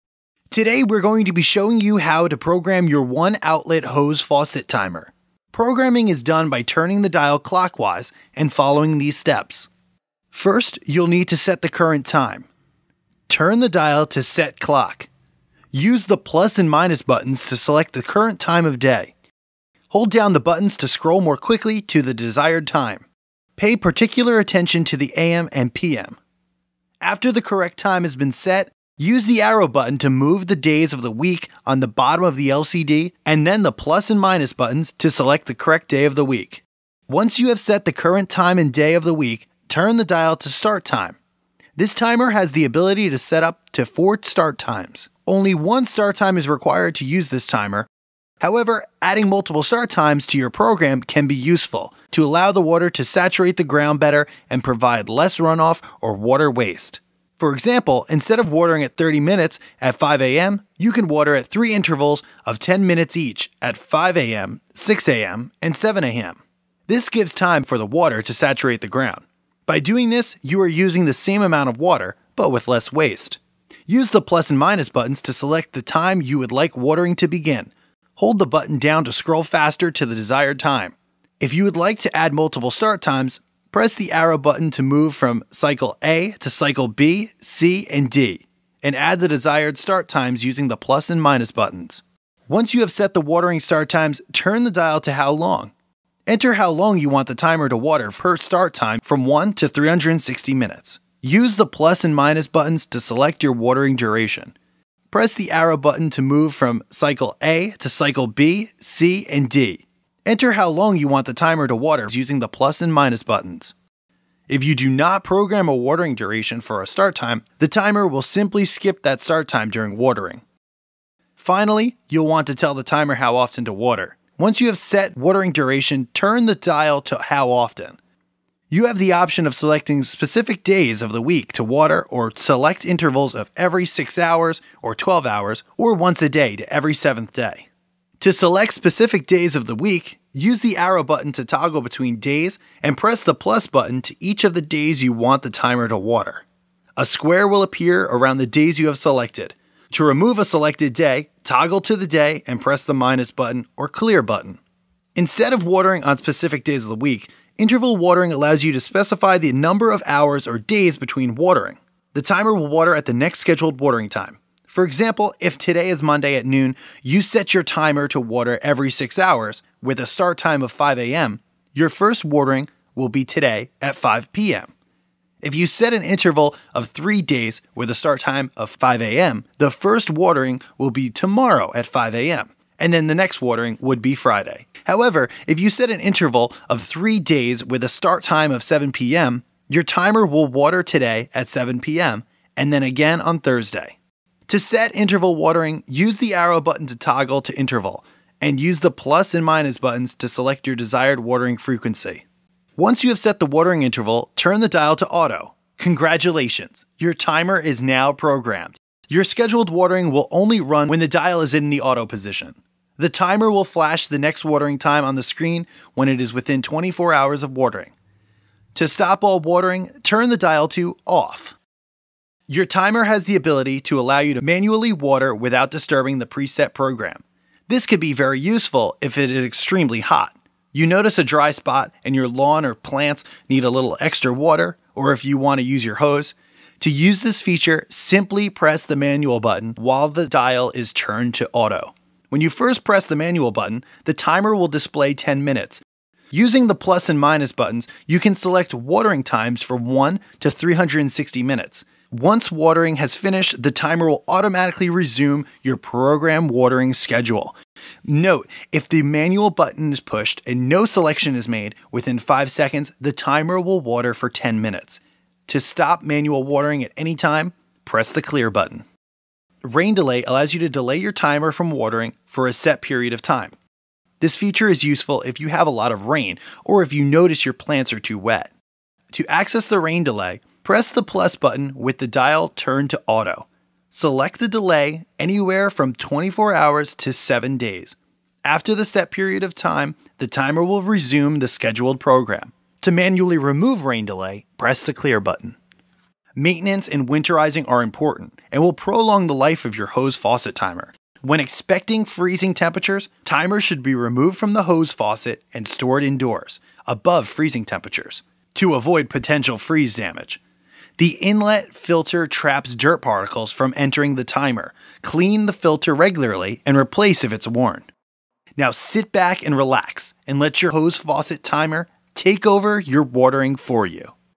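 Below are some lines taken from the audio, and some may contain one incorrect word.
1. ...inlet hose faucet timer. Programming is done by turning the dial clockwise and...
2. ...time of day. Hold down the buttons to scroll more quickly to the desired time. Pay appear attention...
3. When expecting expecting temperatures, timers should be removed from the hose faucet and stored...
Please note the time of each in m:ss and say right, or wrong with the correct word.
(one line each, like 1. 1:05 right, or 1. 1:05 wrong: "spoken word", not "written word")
1. 0:03 wrong: "outlet", not "inlet"
2. 0:18 wrong: "particular", not "appear"
3. 5:01 wrong: "freezing", not "expecting".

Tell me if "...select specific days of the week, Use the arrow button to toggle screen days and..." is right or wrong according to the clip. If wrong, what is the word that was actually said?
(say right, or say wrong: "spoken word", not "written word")
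wrong: "between", not "screen".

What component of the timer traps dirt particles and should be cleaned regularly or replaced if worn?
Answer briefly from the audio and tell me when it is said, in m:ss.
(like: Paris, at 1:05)
Inlet filter, at 5:11.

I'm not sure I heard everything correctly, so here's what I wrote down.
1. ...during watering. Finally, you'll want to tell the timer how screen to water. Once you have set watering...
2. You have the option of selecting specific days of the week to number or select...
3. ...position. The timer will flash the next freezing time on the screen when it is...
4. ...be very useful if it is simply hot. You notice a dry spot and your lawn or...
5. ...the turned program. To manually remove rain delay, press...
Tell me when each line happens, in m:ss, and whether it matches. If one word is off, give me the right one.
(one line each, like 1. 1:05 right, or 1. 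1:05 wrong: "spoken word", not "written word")
1. 1:59 wrong: "often", not "screen"
2. 2:08 wrong: "water", not "number"
3. 3:32 wrong: "watering", not "freezing"
4. 3:48 wrong: "extremely", not "simply"
5. 4:51 wrong: "scheduled", not "turned".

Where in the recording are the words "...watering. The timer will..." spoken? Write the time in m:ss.
2:41.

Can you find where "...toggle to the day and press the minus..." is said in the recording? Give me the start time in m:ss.
2:31.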